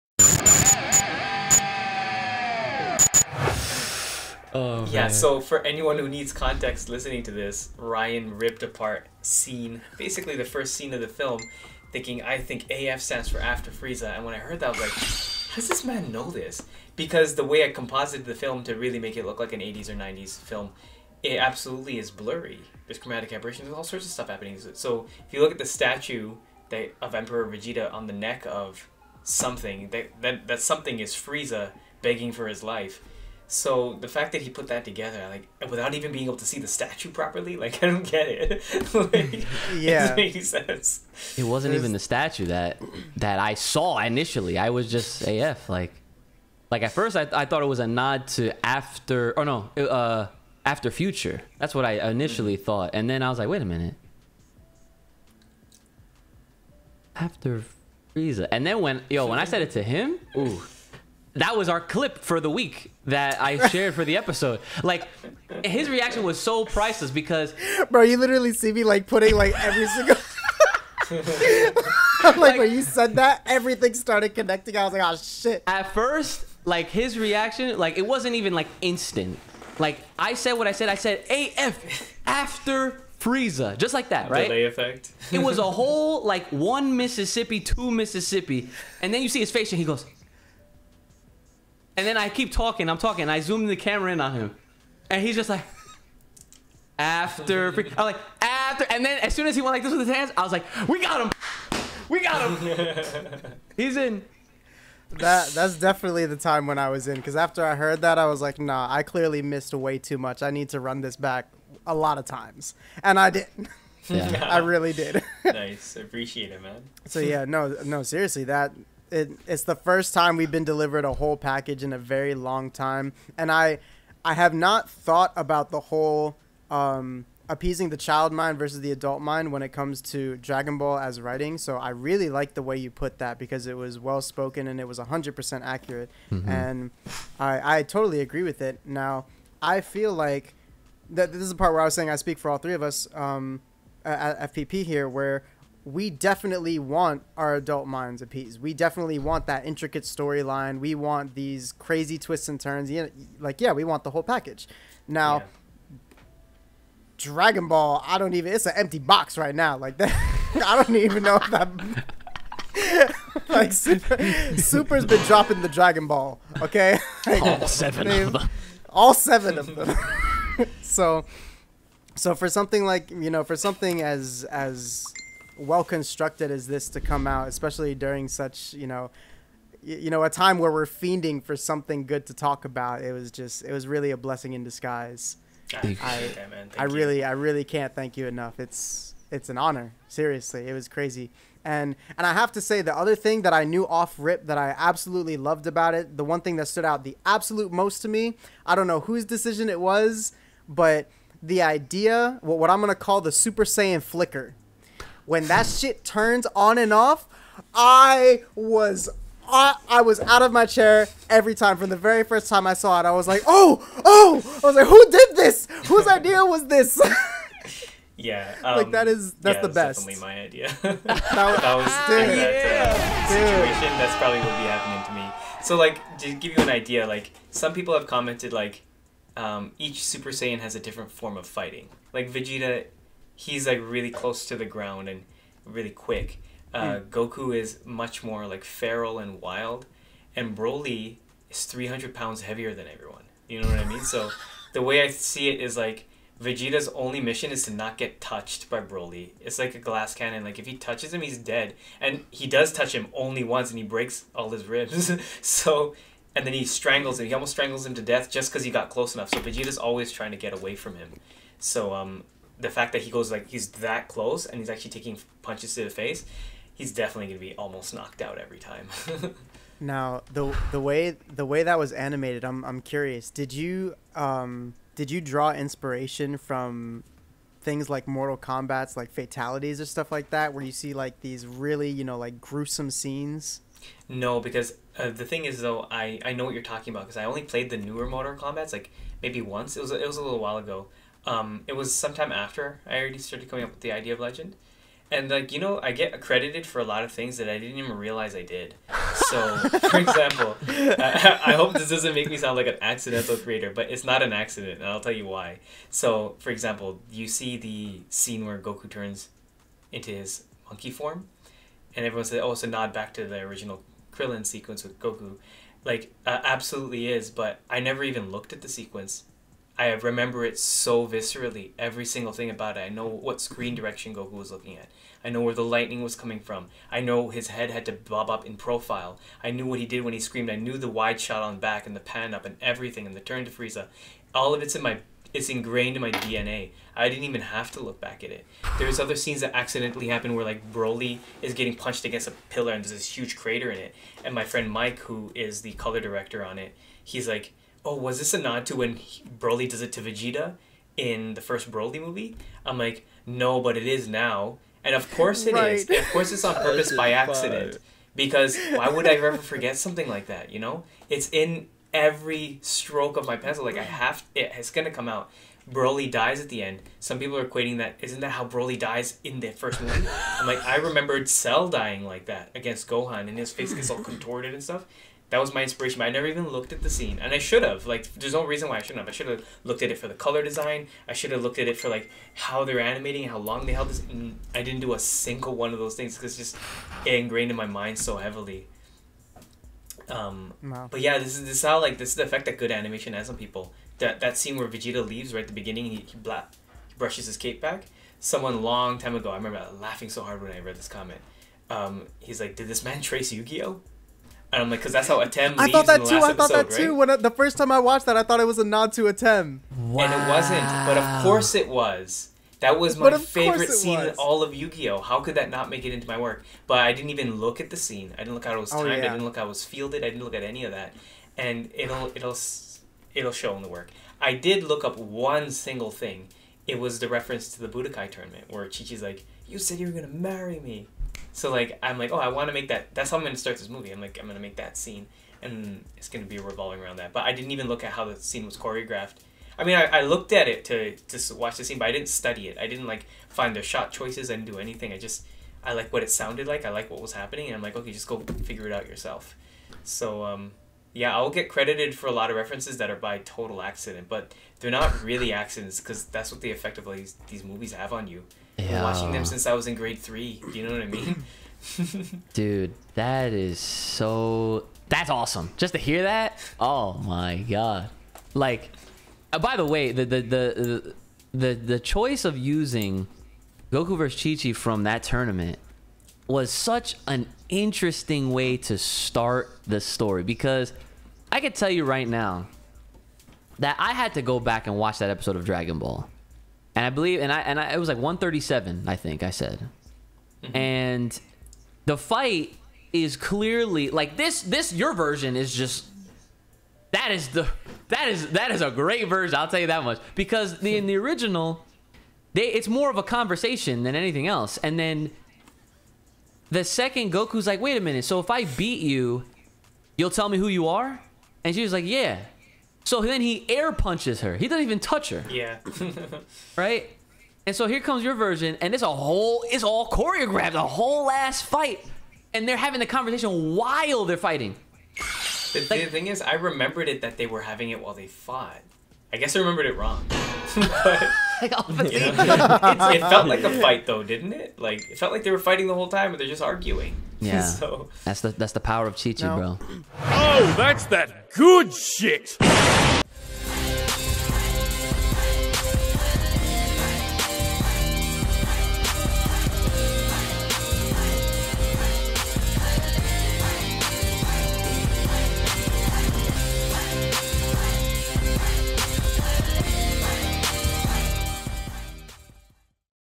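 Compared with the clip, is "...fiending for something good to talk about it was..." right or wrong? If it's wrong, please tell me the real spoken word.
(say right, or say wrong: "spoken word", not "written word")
right.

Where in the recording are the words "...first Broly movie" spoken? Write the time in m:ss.
5:51.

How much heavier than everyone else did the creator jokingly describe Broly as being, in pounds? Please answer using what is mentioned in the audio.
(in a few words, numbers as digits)
300.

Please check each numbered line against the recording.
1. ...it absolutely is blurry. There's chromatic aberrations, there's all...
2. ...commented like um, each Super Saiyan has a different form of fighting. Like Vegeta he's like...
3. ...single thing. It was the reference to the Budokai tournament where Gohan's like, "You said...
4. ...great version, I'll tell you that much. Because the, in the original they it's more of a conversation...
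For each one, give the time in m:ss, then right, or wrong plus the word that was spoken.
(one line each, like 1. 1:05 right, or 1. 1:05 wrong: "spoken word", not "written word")
1. 0:21 right
2. 3:48 right
3. 7:05 wrong: "Chichi", not "Gohan"
4. 8:18 right.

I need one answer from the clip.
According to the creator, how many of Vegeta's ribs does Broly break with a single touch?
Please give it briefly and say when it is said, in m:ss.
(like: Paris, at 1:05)
All his ribs, at 4:14.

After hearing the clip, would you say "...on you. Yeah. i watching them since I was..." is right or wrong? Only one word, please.
right.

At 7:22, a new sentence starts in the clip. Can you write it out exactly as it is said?
I didn't like find the shot choices.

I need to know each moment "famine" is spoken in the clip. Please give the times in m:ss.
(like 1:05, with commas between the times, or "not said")
not said.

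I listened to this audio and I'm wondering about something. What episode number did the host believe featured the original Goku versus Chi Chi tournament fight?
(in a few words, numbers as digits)
137.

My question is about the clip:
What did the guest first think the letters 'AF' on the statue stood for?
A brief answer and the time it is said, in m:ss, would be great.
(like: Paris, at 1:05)
After future, at 0:50.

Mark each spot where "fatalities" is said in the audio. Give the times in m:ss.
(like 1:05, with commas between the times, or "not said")
4:39.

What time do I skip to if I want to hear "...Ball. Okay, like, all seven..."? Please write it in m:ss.
2:46.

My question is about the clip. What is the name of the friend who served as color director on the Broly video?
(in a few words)
Mike.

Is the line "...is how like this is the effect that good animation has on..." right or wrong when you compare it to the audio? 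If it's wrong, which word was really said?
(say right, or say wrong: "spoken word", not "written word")
right.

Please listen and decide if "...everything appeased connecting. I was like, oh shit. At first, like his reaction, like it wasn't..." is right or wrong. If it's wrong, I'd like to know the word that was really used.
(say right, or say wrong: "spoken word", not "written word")
wrong: "started", not "appeased".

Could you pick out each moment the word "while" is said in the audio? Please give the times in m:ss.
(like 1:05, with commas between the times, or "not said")
4:50, 8:43, 8:47.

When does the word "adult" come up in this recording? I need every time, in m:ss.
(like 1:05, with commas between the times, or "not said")
2:08, 2:27.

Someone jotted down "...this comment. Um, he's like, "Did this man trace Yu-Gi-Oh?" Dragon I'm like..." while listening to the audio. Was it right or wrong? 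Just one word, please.
wrong.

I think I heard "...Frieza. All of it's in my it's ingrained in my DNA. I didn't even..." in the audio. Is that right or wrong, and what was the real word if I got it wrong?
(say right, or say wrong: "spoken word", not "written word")
right.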